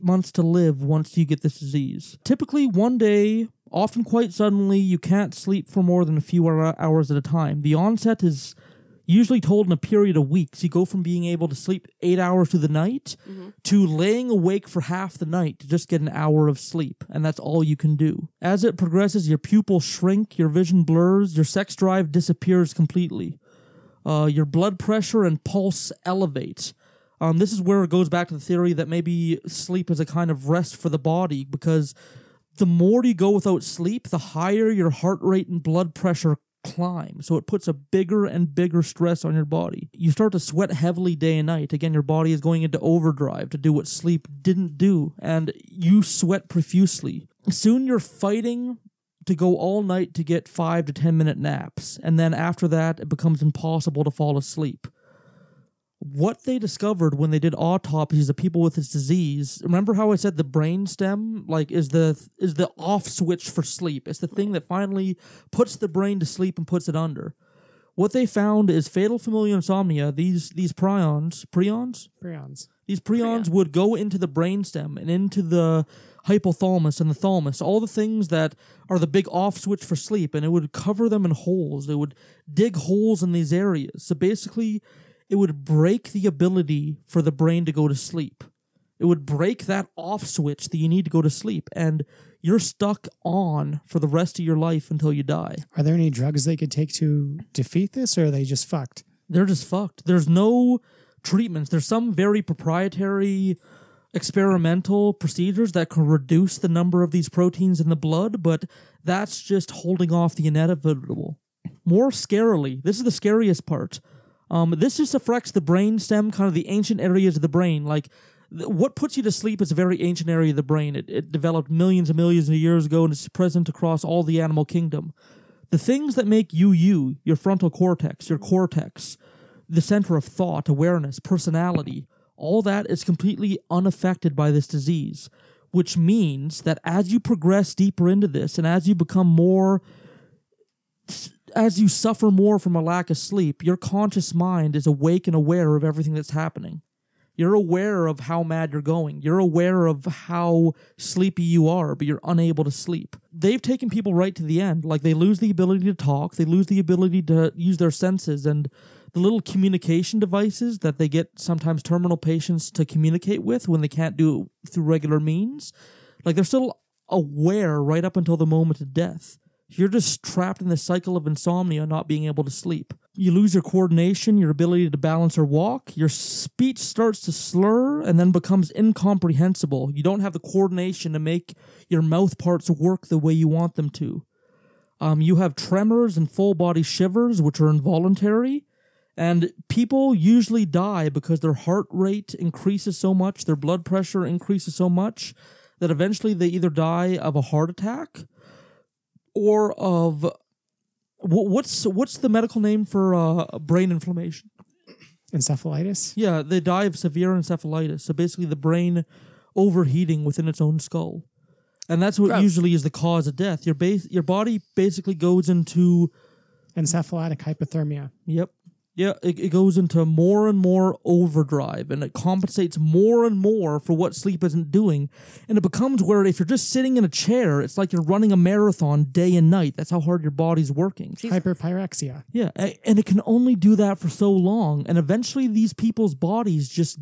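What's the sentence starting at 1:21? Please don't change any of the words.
It would dig holes in these areas.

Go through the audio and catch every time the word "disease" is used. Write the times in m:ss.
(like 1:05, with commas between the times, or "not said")
0:01, 0:58, 2:14.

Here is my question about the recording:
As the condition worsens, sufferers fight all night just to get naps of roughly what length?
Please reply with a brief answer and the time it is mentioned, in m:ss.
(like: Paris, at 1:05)
5 to 10 minutes, at 0:50.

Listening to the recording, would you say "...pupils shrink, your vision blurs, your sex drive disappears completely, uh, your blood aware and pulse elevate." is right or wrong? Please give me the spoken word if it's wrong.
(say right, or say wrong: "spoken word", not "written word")
wrong: "pressure", not "aware".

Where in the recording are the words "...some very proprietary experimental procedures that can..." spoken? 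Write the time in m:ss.
1:41.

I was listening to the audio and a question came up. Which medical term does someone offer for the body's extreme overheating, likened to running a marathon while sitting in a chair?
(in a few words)
Hyperpyrexia.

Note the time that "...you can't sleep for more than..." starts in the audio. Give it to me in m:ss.
0:04.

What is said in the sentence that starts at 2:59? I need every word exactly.
You don't have the coordination to make your mouth parts work the way you want them to.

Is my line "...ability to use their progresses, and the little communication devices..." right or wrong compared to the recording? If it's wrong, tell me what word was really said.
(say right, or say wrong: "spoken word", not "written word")
wrong: "senses", not "progresses".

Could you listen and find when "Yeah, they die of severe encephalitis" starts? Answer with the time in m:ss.
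3:26.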